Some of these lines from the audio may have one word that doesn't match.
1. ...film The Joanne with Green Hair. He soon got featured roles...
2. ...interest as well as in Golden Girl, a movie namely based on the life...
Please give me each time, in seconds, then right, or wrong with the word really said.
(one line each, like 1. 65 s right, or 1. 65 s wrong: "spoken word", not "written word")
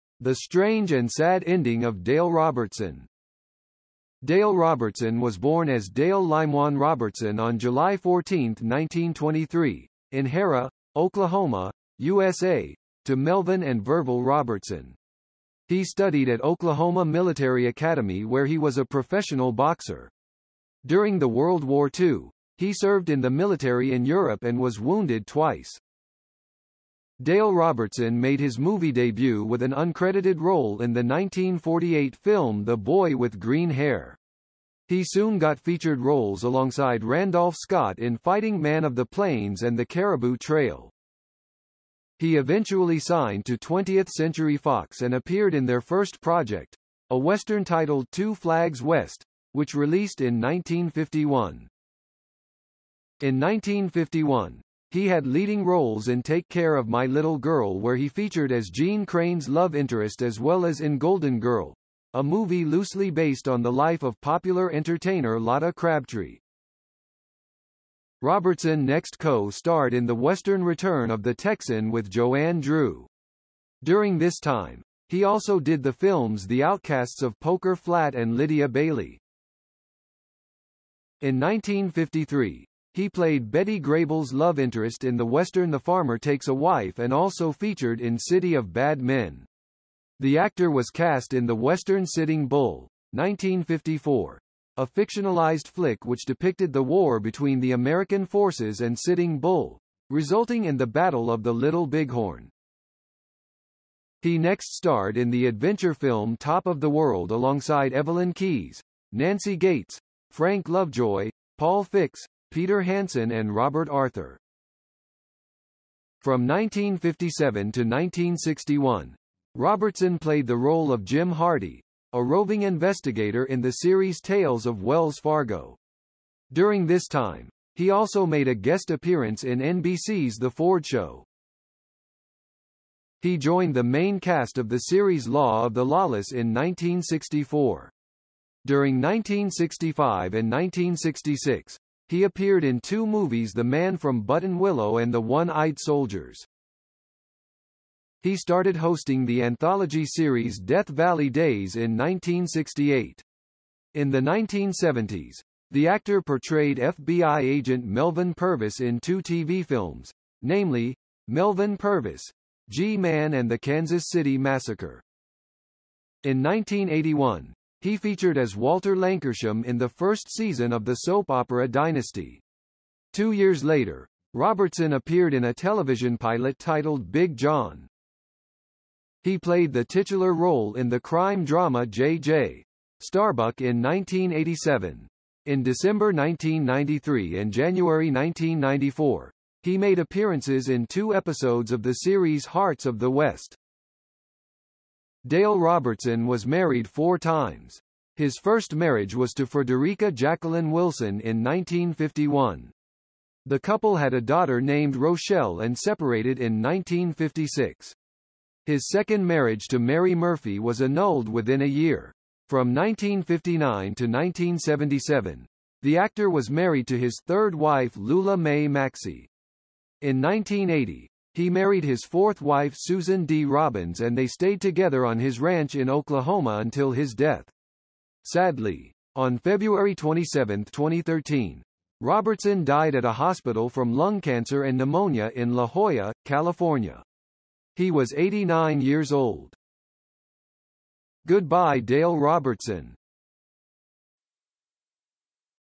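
1. 32 s wrong: "Boy", not "Joanne"
2. 59 s wrong: "loosely", not "namely".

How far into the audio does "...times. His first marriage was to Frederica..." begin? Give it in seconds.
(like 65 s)
197 s.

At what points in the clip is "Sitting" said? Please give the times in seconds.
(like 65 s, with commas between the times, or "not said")
92 s, 98 s.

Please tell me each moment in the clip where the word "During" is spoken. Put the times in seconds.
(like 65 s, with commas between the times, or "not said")
20 s, 73 s, 126 s, 138 s.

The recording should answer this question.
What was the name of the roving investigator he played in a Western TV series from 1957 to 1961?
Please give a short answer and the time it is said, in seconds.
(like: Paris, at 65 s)
Jim Hardy, at 121 s.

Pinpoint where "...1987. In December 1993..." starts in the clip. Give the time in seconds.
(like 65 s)
183 s.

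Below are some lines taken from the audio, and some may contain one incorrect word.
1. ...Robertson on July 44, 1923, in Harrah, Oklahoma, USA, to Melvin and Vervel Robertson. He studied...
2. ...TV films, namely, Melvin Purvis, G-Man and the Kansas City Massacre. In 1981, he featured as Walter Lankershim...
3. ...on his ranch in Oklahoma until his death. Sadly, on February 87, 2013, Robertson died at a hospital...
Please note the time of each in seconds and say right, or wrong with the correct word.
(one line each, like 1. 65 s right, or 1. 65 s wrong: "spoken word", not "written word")
1. 6 s wrong: "14", not "44"
2. 159 s right
3. 225 s wrong: "27", not "87".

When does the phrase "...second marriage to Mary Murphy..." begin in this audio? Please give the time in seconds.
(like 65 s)
208 s.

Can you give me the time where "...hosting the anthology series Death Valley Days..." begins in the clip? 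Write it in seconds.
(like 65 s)
148 s.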